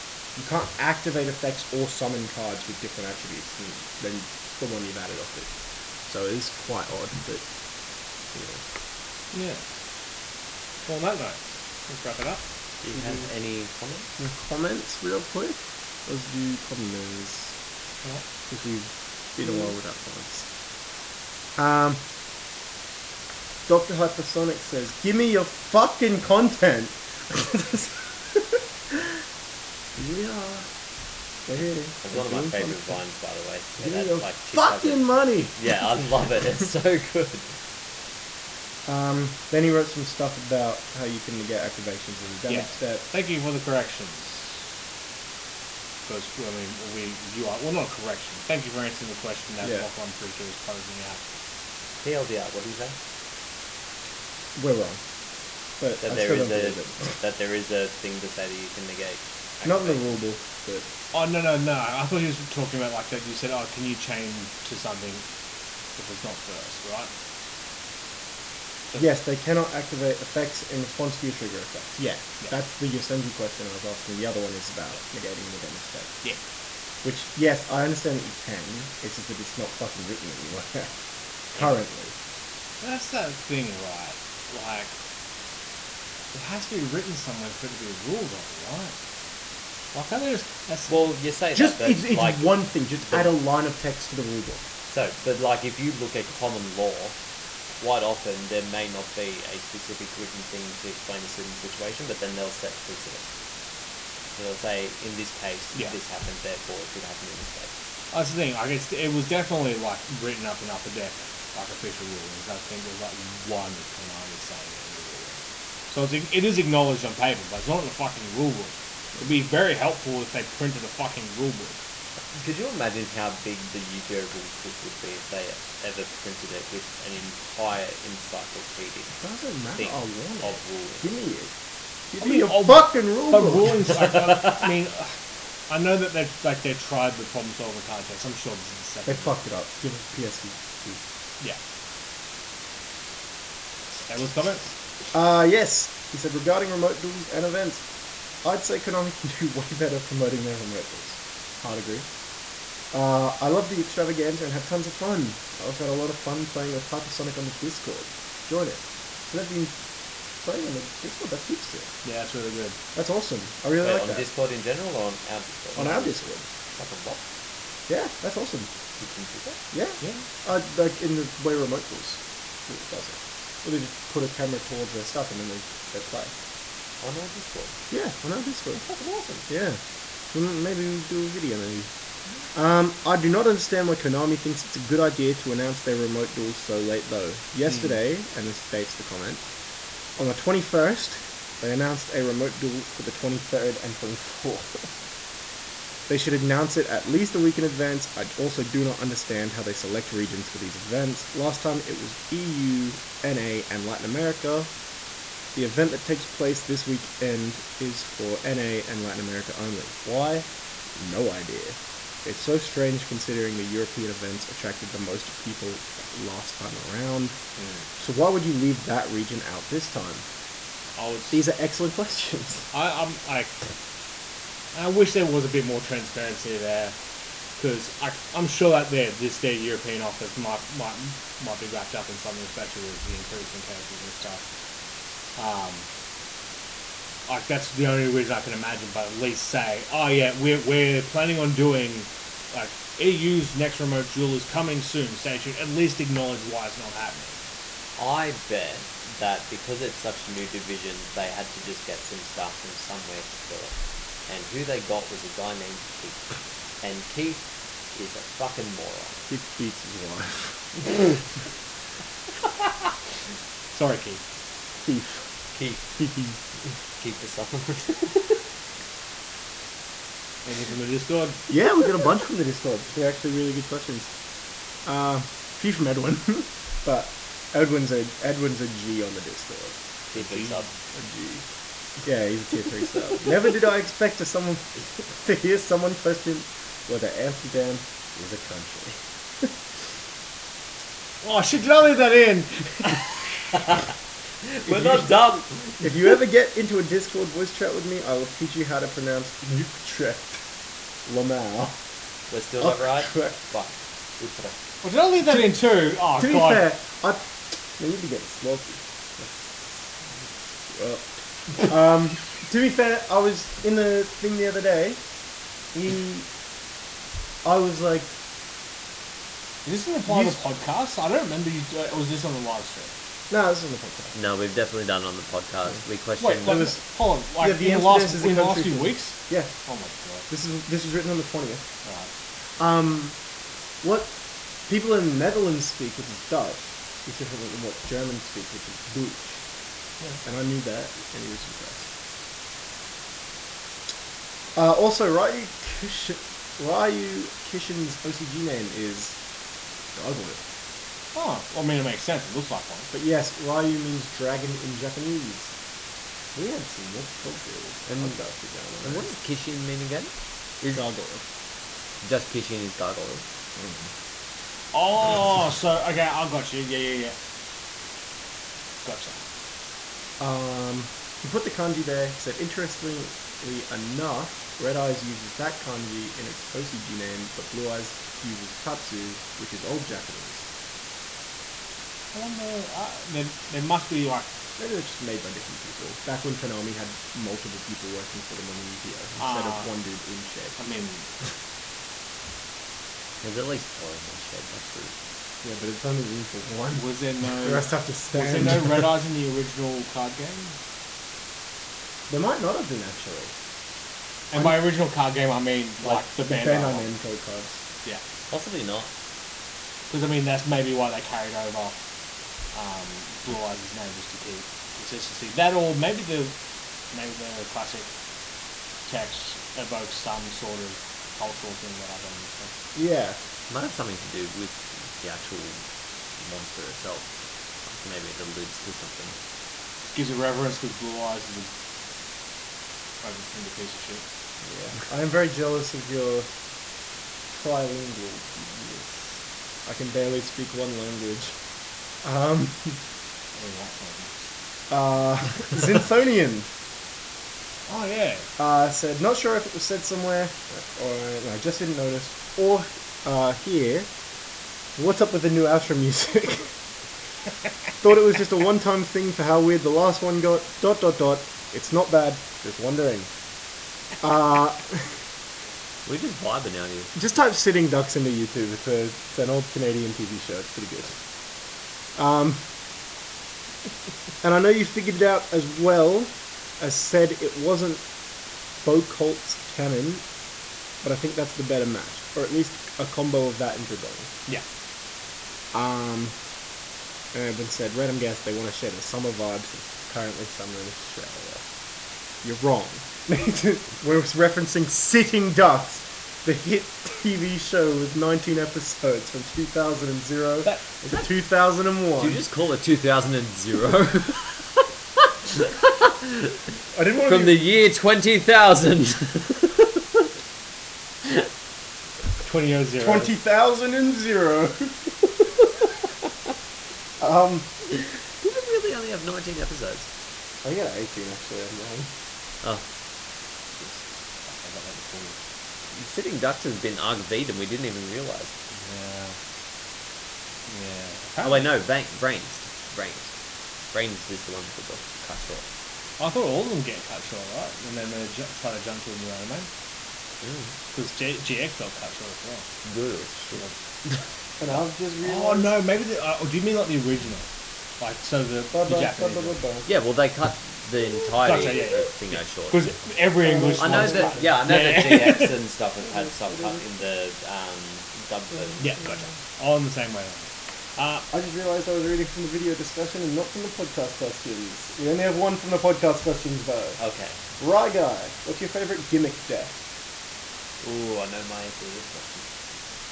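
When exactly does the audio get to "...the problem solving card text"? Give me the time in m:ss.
2:17.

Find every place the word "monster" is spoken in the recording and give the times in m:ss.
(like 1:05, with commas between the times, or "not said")
7:06.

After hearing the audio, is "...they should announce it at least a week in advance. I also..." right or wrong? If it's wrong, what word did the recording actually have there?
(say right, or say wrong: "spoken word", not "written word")
right.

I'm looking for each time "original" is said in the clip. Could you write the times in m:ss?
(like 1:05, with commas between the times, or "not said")
6:39, 6:44, 9:06.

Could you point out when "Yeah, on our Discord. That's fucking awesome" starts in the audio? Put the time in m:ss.
2:57.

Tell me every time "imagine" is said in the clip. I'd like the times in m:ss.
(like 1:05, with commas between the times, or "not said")
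2:02, 3:58.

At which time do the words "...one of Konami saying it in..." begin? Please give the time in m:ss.
1:53.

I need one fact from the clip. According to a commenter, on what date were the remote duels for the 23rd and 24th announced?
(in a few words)
21st.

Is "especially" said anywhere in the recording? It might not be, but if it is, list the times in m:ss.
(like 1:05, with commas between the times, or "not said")
3:52.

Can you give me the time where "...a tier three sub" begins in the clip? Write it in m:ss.
4:42.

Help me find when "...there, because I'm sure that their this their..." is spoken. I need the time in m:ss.
3:46.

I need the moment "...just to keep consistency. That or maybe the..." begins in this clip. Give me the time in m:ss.
6:53.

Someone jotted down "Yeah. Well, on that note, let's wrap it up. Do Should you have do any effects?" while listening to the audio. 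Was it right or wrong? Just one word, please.
wrong.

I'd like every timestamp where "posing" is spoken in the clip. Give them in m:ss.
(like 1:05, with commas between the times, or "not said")
0:50.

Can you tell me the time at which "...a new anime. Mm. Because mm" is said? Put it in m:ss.
8:58.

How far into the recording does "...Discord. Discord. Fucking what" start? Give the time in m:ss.
2:46.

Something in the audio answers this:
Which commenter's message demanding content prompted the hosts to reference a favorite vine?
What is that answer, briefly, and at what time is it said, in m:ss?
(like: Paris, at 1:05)
Doctor Hypersonic, at 0:23.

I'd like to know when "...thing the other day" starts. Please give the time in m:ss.
5:14.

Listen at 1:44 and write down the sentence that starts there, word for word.
So they'll say, in this case, Yeah.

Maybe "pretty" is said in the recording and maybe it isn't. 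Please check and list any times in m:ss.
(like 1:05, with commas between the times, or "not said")
0:50, 7:50.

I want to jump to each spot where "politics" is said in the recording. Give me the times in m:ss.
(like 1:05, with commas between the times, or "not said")
not said.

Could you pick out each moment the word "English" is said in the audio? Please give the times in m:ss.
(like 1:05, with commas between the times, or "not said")
7:23, 9:13.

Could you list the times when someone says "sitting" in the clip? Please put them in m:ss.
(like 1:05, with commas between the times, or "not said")
7:47, 8:14, 8:45.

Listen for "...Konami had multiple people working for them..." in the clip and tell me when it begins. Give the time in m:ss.
6:26.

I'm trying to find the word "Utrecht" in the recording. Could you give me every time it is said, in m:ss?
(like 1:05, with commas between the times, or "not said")
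4:59, 5:04.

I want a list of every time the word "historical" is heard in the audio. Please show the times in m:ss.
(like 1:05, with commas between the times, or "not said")
not said.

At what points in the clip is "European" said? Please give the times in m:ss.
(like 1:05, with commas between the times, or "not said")
3:33, 3:49.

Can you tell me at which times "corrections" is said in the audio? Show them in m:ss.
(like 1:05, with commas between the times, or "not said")
0:43, 0:47.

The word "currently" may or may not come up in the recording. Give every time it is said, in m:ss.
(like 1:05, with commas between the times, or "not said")
1:21, 8:09.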